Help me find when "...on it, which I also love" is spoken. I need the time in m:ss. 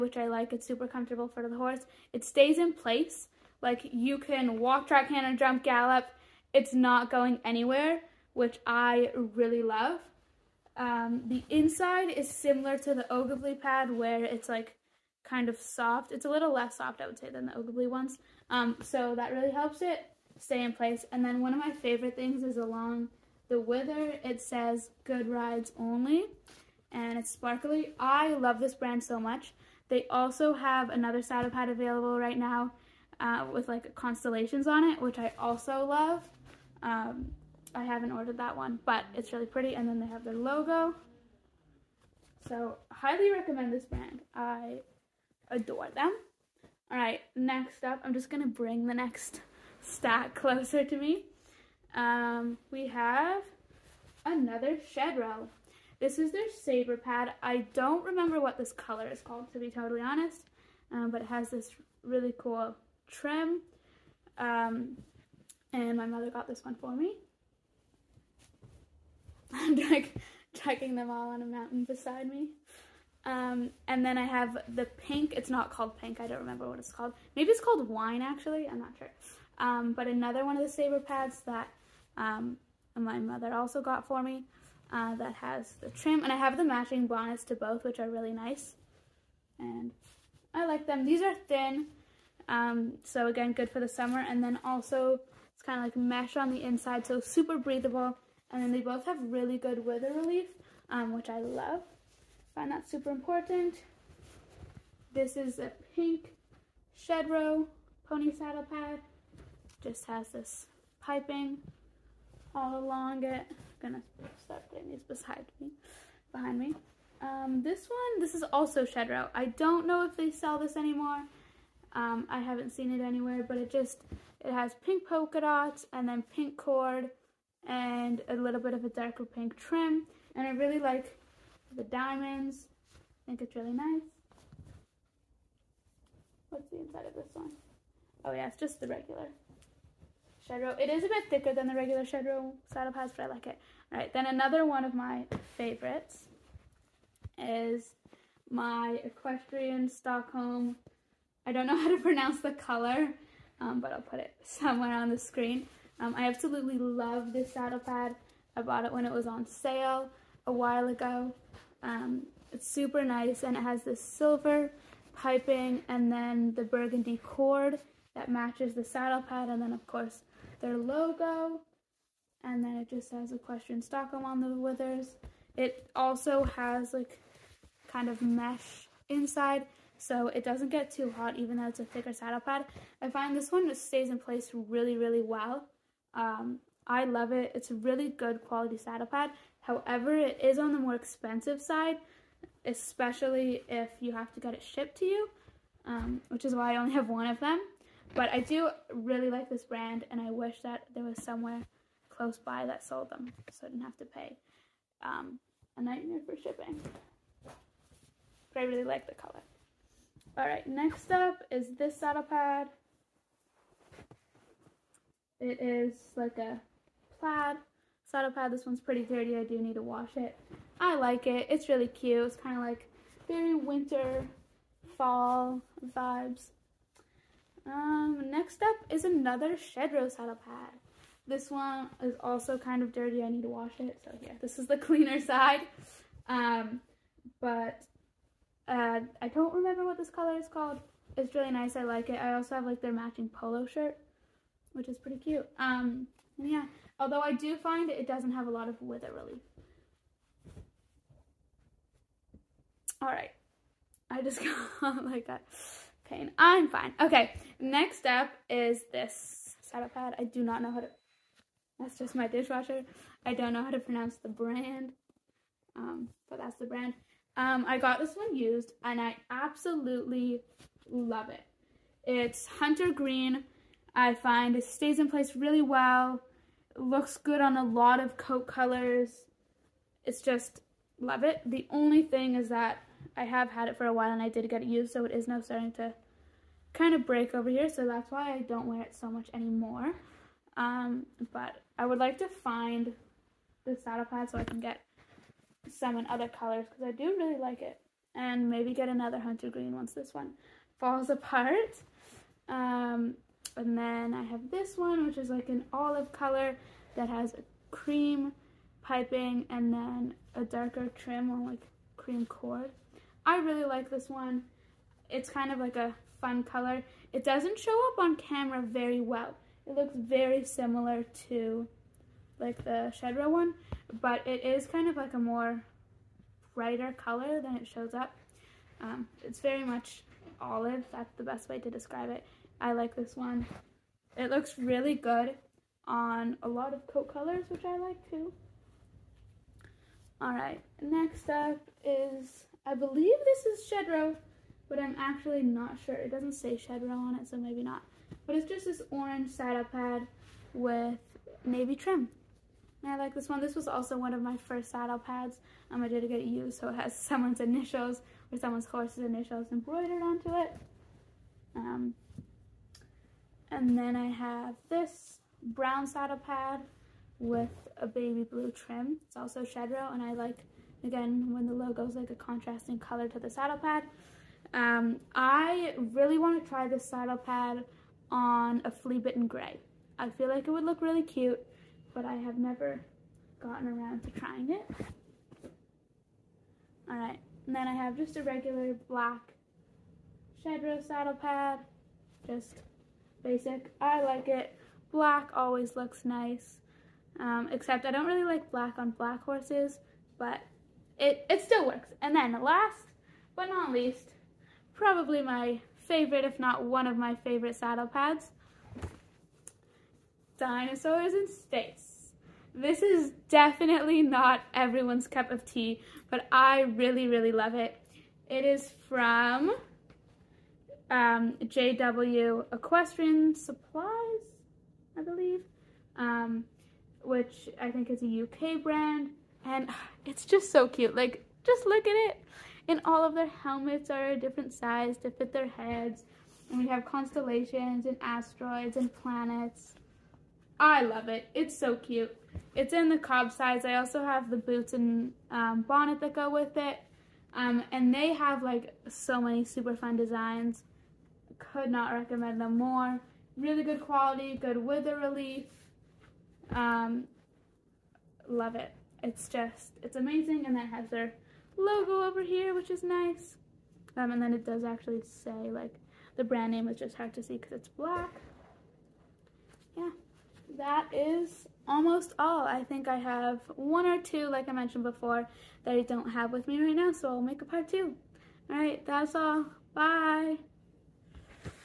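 0:34.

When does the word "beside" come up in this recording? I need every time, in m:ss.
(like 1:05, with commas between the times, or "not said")
1:11, 1:55.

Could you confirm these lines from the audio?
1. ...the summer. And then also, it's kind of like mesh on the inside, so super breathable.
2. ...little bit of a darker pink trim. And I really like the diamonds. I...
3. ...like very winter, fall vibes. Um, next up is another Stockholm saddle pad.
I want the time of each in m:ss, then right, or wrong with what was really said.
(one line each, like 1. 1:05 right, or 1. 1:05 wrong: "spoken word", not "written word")
1. 1:33 right
2. 2:08 right
3. 3:42 wrong: "Shedrow", not "Stockholm".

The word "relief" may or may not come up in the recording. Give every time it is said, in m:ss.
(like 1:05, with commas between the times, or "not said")
1:40, 4:09, 7:34.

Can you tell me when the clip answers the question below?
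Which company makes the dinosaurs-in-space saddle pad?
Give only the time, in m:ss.
7:01.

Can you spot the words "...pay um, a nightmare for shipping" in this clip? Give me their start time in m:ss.
3:24.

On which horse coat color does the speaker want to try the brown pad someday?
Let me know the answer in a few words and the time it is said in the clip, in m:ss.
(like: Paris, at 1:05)
Flea bitten gray, at 6:18.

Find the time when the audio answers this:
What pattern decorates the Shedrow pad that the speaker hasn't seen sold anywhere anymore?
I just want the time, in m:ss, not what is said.
2:04.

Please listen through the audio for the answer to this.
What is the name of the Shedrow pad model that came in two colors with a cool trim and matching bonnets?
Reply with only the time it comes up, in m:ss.
0:56.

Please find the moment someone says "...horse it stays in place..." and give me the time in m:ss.
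0:01.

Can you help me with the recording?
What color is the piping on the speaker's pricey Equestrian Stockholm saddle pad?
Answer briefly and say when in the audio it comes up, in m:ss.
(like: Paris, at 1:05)
Silver, at 2:44.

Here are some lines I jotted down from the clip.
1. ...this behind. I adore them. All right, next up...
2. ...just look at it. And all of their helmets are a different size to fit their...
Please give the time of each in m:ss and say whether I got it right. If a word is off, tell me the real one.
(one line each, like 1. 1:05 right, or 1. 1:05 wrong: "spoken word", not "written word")
1. 0:43 wrong: "brand", not "behind"
2. 7:11 right.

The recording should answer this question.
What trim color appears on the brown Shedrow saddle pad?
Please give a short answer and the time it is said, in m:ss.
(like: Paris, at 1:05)
Baby blue, at 6:07.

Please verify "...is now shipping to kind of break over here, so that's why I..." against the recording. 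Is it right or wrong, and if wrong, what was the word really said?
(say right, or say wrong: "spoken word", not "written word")
wrong: "starting", not "shipping".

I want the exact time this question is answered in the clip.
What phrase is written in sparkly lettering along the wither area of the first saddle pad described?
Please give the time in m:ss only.
0:25.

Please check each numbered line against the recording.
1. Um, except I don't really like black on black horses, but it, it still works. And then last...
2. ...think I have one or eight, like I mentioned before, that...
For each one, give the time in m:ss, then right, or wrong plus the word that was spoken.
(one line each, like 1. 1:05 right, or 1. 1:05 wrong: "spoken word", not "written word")
1. 6:37 right
2. 7:52 wrong: "two", not "eight".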